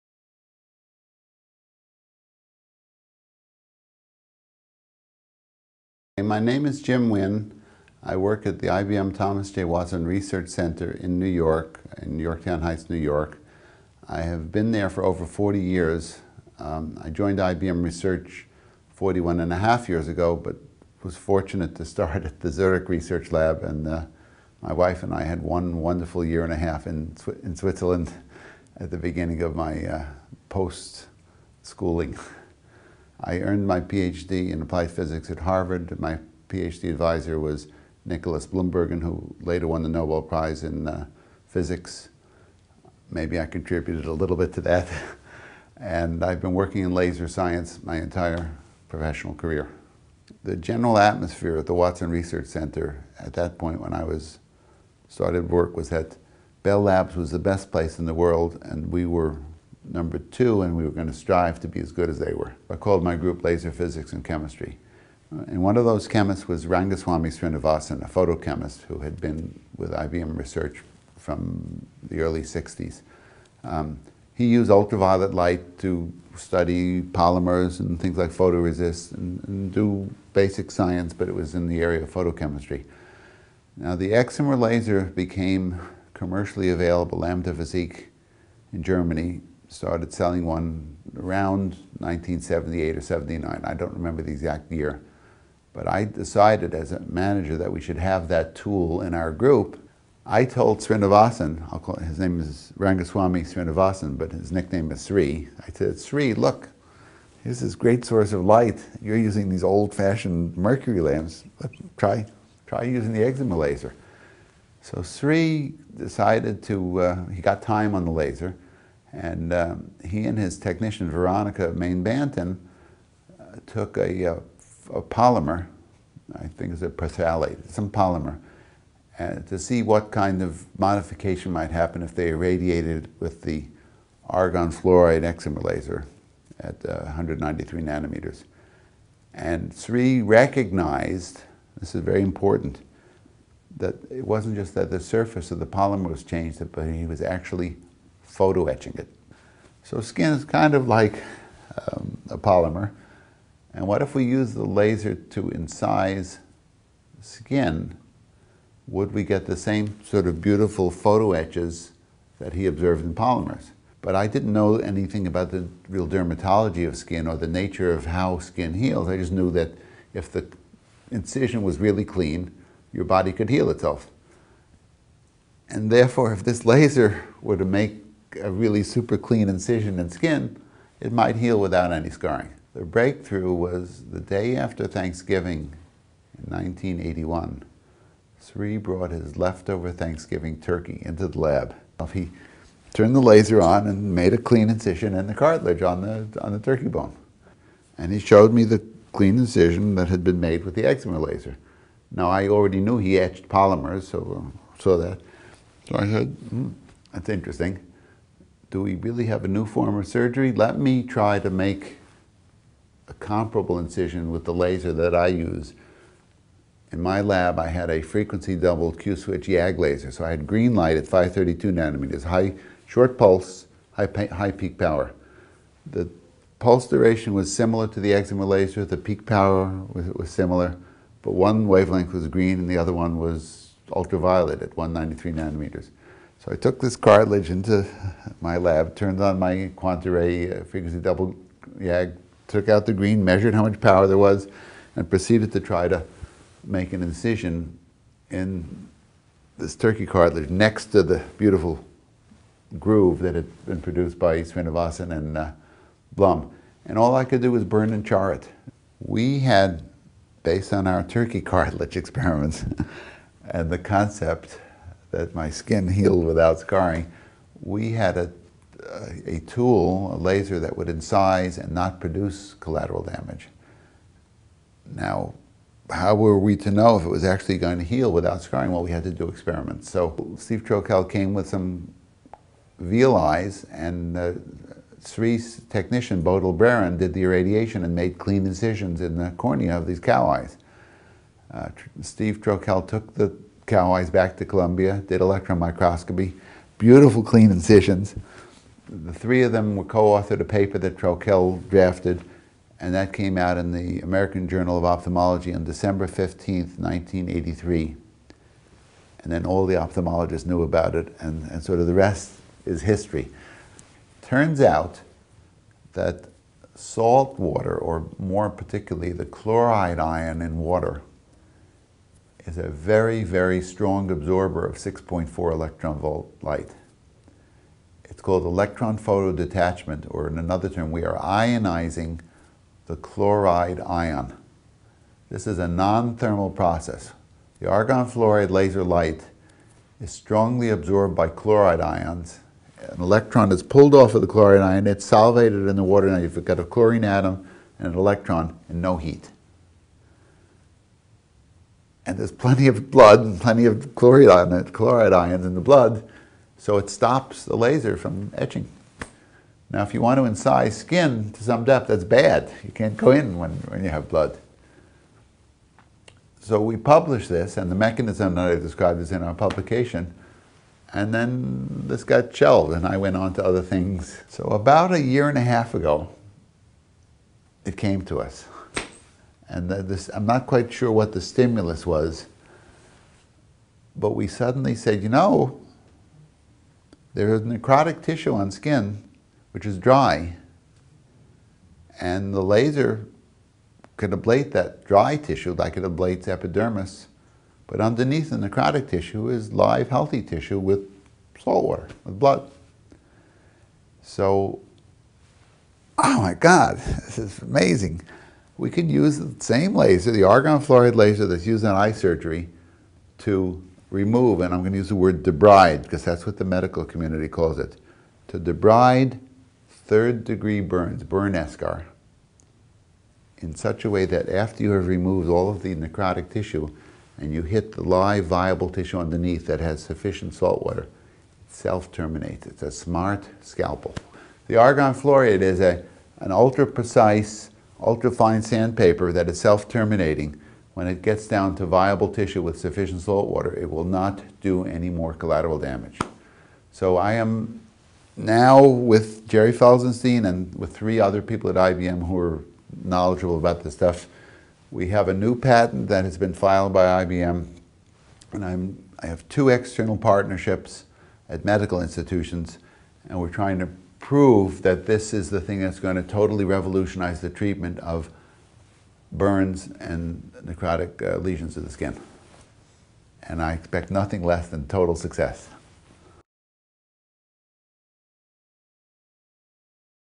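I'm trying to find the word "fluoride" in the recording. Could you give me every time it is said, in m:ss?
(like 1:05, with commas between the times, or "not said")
2:14, 5:38, 6:50, 7:14.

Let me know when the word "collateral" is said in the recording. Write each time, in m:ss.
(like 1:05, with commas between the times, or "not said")
4:32, 7:25.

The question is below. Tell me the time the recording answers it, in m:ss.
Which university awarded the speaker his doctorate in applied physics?
0:35.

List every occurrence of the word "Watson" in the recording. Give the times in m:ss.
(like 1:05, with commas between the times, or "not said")
0:09, 0:51.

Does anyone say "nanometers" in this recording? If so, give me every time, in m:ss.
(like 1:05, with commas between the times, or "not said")
2:17, 3:41, 3:55.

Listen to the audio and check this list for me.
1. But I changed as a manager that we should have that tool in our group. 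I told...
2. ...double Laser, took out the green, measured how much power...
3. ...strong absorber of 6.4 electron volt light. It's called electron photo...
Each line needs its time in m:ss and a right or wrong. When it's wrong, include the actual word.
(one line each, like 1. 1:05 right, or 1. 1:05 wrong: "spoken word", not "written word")
1. 1:35 wrong: "decided", not "changed"
2. 4:00 wrong: "YAG", not "Laser"
3. 5:23 right.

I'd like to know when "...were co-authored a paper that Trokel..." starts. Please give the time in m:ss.
4:59.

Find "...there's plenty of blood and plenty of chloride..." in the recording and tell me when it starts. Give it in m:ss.
5:52.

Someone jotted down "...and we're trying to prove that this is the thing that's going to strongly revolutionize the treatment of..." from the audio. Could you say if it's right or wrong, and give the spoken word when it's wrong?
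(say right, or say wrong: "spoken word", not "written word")
wrong: "totally", not "strongly".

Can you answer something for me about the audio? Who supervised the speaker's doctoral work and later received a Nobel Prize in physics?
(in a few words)
Nicholas Bloembergen.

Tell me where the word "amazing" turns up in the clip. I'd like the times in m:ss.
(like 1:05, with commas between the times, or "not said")
6:47.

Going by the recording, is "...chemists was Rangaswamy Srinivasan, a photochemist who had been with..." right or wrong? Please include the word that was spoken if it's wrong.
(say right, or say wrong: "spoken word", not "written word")
right.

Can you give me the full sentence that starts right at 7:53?
And I expect nothing less than total success.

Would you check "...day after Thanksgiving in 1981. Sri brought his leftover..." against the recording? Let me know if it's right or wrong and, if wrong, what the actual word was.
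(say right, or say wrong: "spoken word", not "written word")
right.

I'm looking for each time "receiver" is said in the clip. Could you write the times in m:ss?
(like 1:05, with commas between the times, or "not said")
not said.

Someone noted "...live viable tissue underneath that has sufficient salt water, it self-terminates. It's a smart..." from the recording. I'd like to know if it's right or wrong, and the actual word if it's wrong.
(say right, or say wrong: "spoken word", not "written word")
right.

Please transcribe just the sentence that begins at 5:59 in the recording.
Now, if you want to incise skin to some depth, that's bad.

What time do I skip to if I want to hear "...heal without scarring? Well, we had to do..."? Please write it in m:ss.
4:37.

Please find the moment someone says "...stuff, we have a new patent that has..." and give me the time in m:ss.
7:33.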